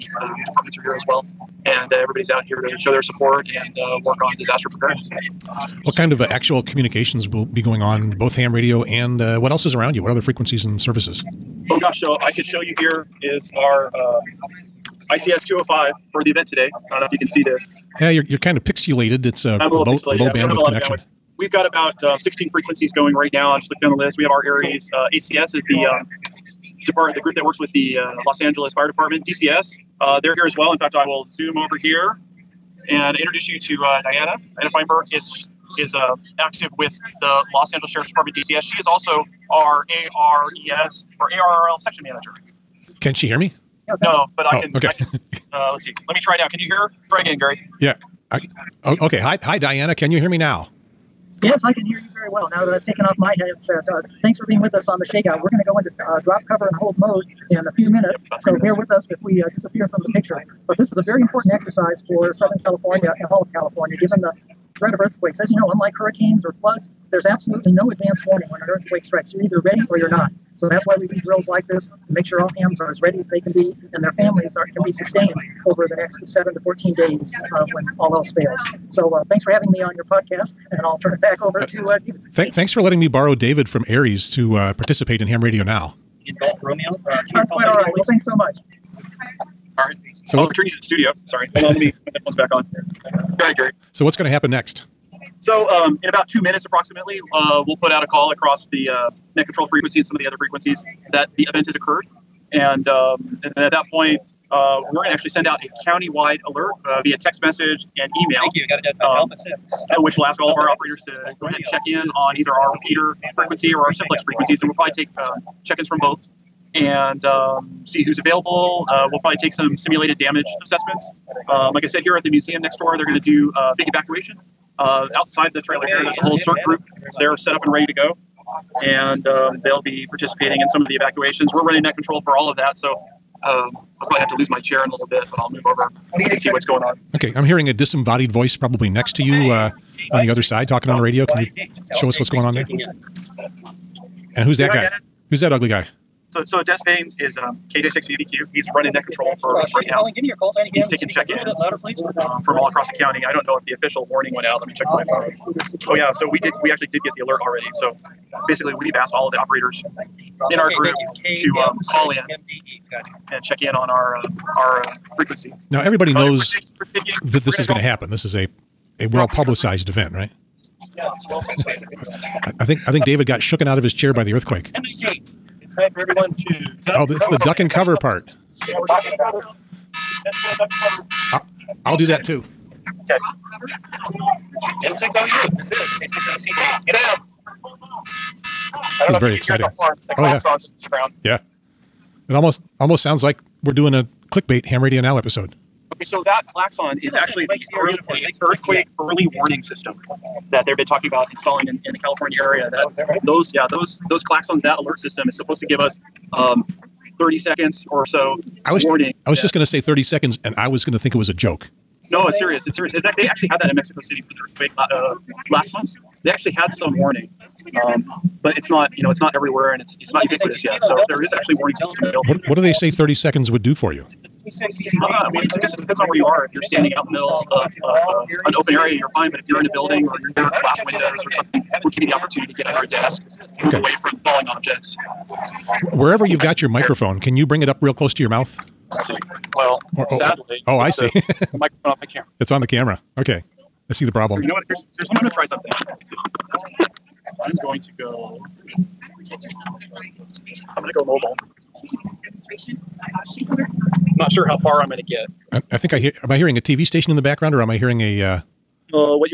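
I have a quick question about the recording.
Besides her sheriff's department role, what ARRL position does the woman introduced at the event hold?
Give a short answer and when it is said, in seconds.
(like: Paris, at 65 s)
section manager, at 41 s.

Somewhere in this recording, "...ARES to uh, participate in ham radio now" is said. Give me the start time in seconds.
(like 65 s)
83 s.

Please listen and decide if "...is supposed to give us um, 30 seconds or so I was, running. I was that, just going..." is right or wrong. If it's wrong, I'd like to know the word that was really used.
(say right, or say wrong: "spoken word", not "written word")
wrong: "warning", not "running".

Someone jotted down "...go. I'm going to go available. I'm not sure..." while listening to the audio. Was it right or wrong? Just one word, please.
wrong.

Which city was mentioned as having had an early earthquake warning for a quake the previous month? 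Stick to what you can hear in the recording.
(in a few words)
Mexico City.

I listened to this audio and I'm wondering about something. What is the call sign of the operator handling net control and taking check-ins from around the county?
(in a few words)
KJ6VBQ.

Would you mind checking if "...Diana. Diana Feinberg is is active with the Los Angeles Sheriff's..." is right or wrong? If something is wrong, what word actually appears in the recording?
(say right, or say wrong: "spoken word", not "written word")
right.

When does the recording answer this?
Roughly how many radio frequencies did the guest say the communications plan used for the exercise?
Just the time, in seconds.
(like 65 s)
22 s.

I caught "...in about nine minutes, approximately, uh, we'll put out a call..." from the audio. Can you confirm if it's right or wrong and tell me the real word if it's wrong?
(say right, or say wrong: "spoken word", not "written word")
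wrong: "two", not "nine".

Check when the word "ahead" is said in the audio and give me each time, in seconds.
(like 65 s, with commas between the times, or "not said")
93 s, 111 s.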